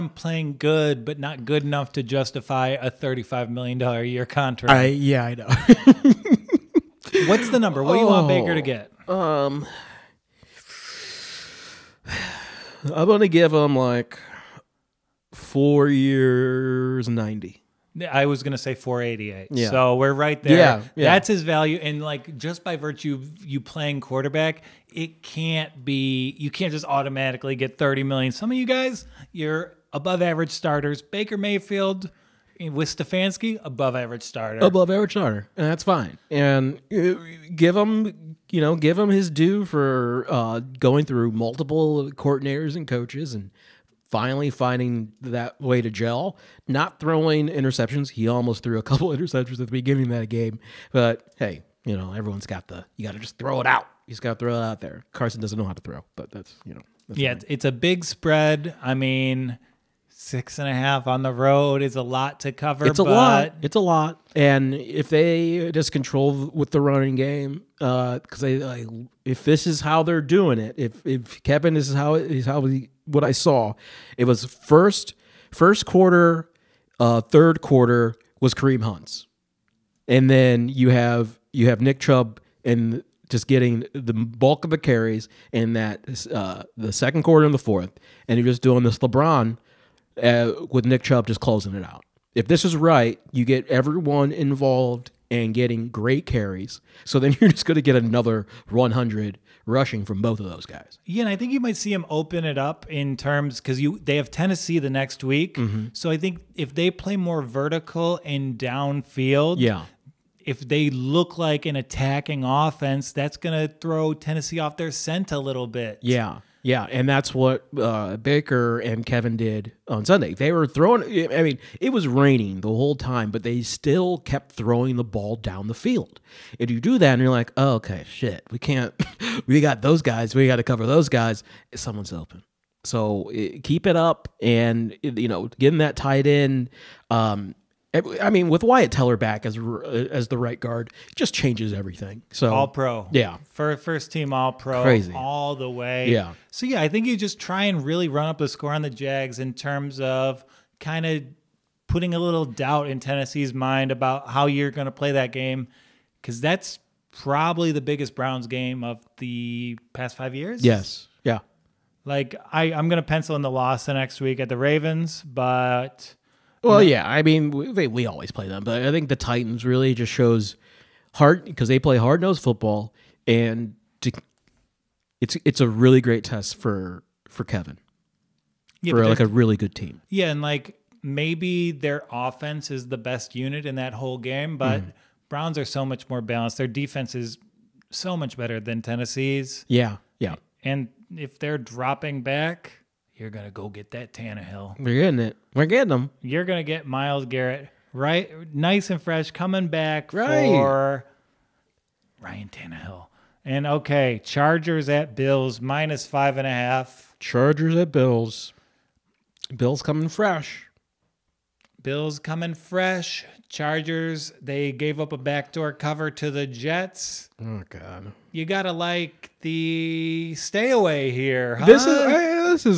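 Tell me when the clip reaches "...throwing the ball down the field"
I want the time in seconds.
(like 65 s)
124 s.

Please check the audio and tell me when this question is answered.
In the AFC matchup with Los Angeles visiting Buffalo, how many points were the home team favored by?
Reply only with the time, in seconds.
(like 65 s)
206 s.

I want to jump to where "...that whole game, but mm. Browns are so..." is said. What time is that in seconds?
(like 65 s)
183 s.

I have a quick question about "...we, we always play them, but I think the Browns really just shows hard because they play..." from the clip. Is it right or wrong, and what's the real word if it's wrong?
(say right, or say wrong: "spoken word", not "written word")
wrong: "Titans", not "Browns".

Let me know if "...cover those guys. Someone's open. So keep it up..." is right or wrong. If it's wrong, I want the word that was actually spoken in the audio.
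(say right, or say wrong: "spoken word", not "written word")
right.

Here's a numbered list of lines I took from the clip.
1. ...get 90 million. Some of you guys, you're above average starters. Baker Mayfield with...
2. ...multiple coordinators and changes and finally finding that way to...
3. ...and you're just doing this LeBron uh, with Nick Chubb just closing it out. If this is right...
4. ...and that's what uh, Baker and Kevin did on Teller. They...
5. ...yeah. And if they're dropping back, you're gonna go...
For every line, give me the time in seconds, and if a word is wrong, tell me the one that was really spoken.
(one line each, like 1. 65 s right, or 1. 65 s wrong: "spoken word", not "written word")
1. 27 s wrong: "30", not "90"
2. 41 s wrong: "coaches", not "changes"
3. 88 s right
4. 116 s wrong: "Sunday", not "Teller"
5. 190 s right.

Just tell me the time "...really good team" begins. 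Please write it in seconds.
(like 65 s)
179 s.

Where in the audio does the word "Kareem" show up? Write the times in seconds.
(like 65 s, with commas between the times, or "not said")
78 s.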